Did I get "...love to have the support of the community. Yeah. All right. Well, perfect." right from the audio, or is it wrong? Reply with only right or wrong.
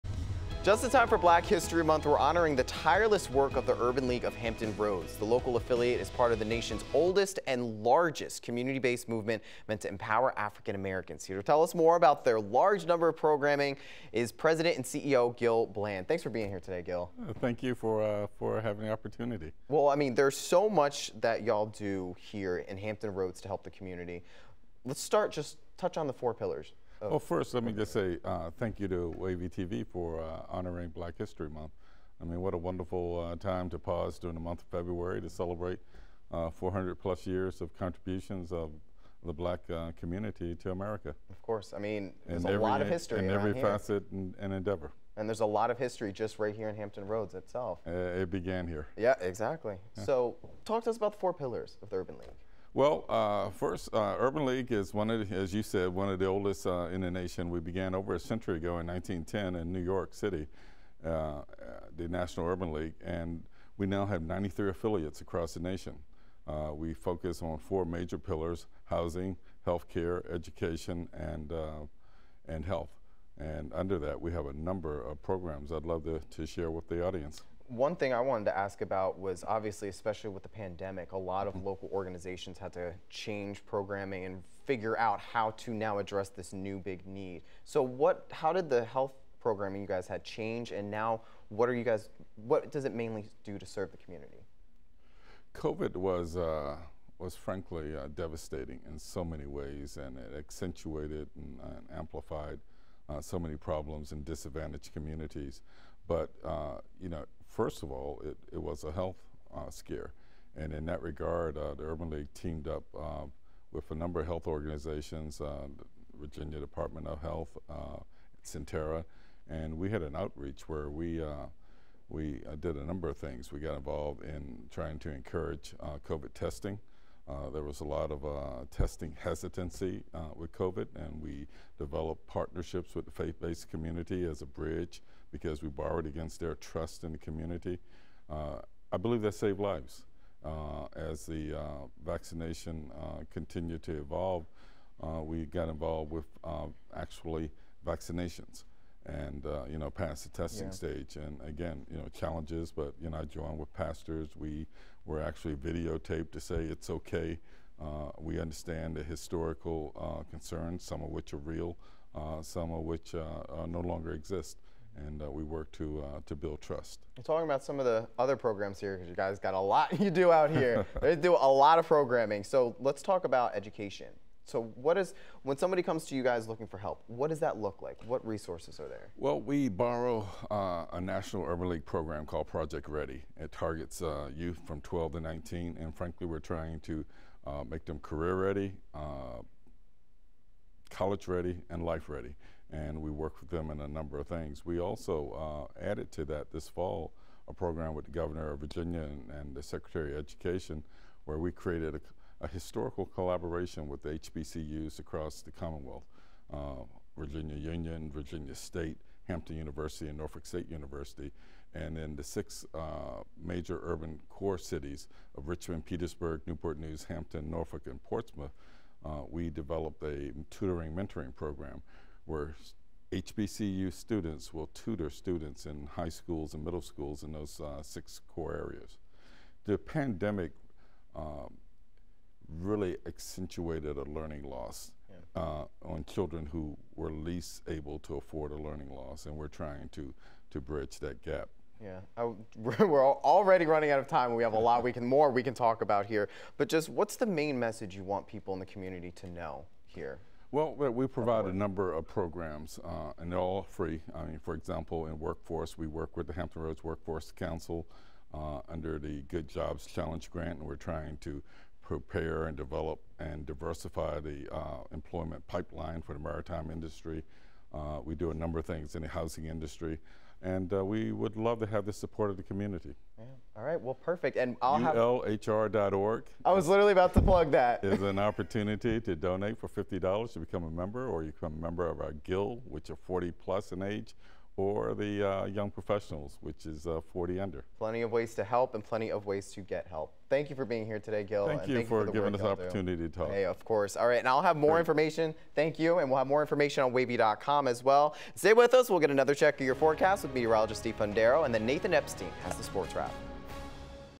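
right.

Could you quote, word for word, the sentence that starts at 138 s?
Uh, I believe that saved lives.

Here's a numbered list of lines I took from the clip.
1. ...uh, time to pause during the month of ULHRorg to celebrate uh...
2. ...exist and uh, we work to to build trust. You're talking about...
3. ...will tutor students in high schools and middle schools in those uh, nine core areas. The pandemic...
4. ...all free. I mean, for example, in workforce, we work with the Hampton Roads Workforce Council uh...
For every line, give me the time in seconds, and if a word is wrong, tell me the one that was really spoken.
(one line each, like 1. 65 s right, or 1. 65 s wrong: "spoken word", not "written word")
1. 33 s wrong: "February", not "ULHRorg"
2. 164 s right
3. 224 s wrong: "six", not "nine"
4. 253 s right.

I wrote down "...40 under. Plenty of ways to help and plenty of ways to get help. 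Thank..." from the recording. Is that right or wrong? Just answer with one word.
right.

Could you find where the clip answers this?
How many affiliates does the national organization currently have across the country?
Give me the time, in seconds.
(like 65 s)
64 s.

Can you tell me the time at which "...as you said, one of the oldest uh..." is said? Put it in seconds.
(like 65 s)
55 s.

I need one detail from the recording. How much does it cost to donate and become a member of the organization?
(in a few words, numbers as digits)
$50.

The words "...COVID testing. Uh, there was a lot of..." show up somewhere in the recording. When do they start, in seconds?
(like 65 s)
126 s.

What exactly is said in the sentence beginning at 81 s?
local organizations had to change programming and figure out how to now address this new big need.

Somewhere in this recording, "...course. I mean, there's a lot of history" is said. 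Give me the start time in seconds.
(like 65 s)
41 s.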